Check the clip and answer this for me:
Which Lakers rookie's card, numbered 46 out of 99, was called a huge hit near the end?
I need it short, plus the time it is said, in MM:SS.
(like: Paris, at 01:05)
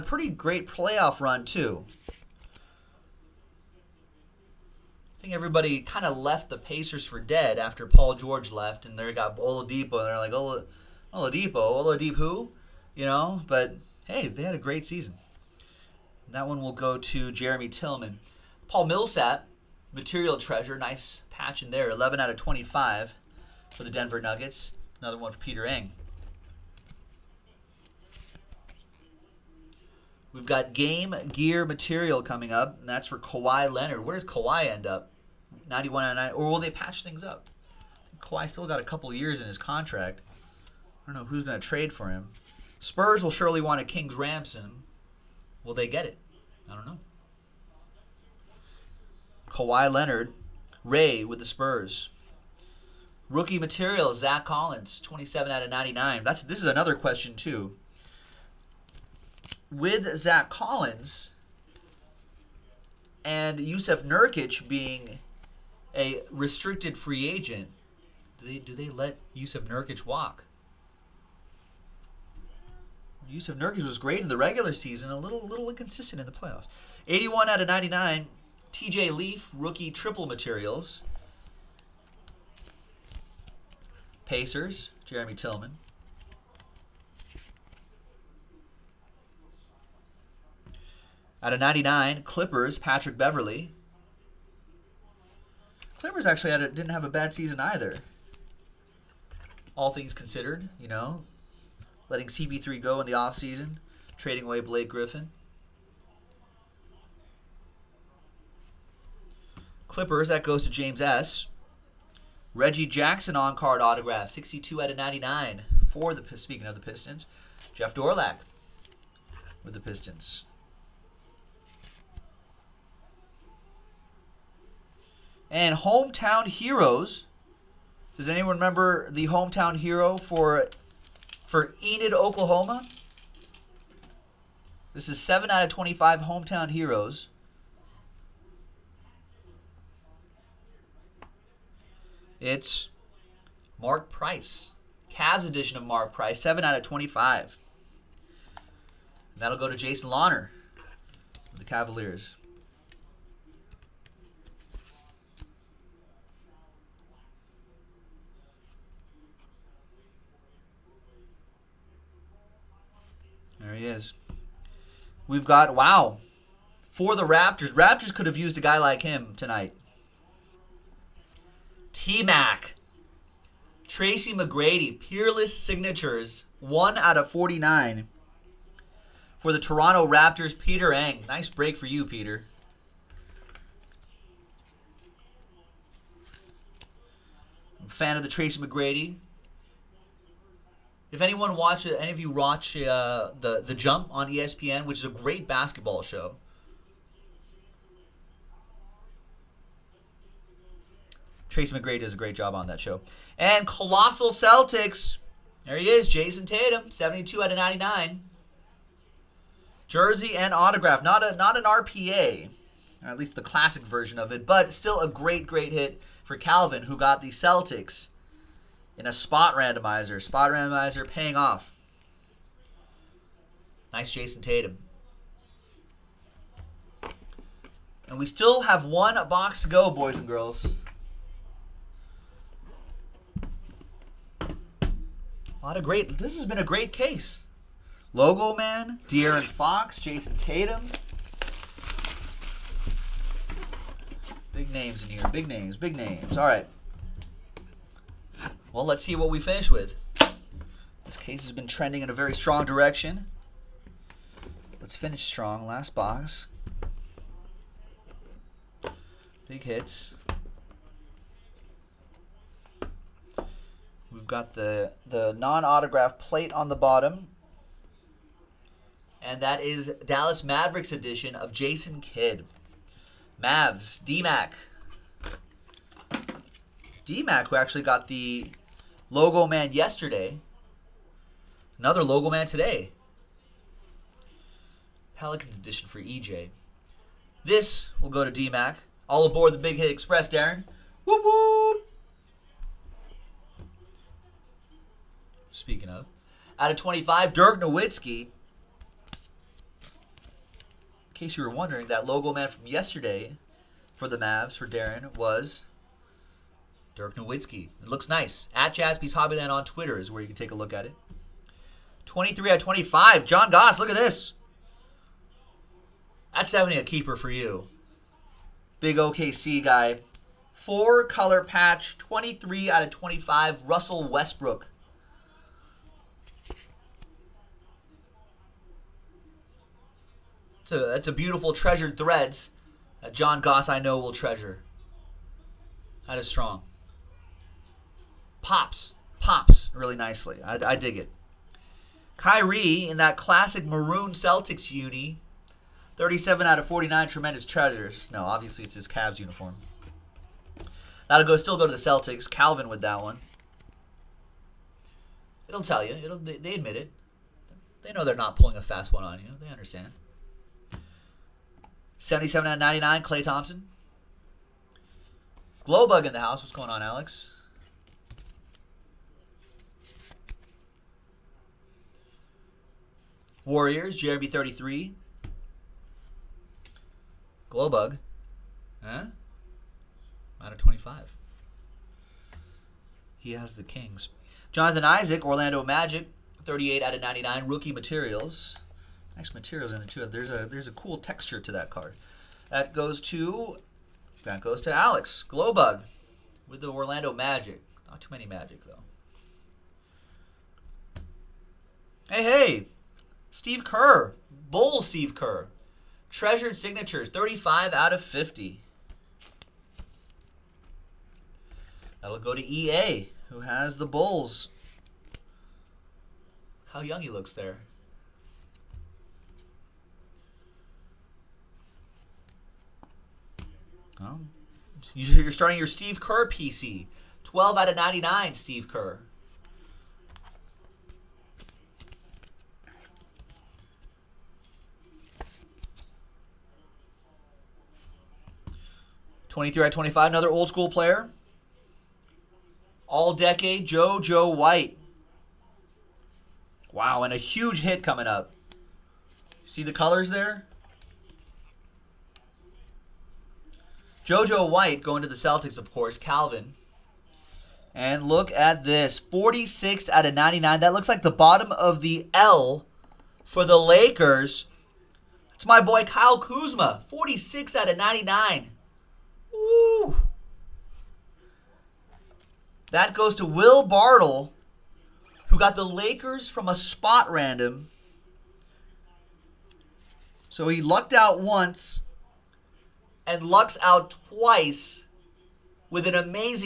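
Kyle Kuzma, at 07:45.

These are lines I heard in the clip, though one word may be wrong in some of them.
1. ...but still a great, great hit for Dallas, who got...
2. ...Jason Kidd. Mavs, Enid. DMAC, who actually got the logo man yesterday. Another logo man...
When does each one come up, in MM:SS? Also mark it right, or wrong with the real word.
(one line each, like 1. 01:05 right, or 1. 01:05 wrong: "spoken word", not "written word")
1. 03:34 wrong: "Calvin", not "Dallas"
2. 04:31 wrong: "DMAC", not "Enid".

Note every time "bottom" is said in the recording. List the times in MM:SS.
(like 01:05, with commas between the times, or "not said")
04:26, 07:41.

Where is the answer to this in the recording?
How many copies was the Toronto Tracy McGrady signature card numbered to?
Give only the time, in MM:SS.
02:56.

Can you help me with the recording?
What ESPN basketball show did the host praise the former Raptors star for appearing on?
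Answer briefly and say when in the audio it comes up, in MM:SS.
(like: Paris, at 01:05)
The Jump, at 03:13.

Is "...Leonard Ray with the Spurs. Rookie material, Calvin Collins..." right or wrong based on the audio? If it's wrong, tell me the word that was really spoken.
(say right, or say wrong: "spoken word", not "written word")
wrong: "Zach", not "Calvin".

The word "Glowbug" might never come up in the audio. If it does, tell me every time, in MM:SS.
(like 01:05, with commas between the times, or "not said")
06:05, 06:17, 06:35.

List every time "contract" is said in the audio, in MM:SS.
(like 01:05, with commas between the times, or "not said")
00:39.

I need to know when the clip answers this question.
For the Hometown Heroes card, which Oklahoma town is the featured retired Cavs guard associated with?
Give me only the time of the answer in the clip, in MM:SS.
02:11.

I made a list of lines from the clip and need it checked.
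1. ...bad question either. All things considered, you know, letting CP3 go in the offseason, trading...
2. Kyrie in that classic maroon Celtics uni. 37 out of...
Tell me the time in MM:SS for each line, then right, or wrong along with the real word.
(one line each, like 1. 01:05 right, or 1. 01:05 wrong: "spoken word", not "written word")
1. 01:37 wrong: "season", not "question"
2. 05:42 right.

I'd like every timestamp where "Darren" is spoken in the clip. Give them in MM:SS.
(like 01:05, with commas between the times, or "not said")
04:50, 05:04.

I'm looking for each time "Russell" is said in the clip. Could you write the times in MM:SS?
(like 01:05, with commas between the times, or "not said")
05:23.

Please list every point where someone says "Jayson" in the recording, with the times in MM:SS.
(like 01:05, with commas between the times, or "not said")
03:26, 03:44, 03:59.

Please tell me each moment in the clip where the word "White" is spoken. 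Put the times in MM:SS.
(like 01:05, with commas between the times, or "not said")
07:24, 07:34.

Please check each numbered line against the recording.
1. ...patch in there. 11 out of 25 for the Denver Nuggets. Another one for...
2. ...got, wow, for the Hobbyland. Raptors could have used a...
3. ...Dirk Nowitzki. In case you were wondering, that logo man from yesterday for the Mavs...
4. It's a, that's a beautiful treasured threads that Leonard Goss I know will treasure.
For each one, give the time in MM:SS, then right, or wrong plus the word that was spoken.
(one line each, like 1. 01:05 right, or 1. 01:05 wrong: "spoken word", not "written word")
1. 00:21 right
2. 02:45 wrong: "Raptors", not "Hobbyland"
3. 04:57 right
4. 05:30 wrong: "John", not "Leonard".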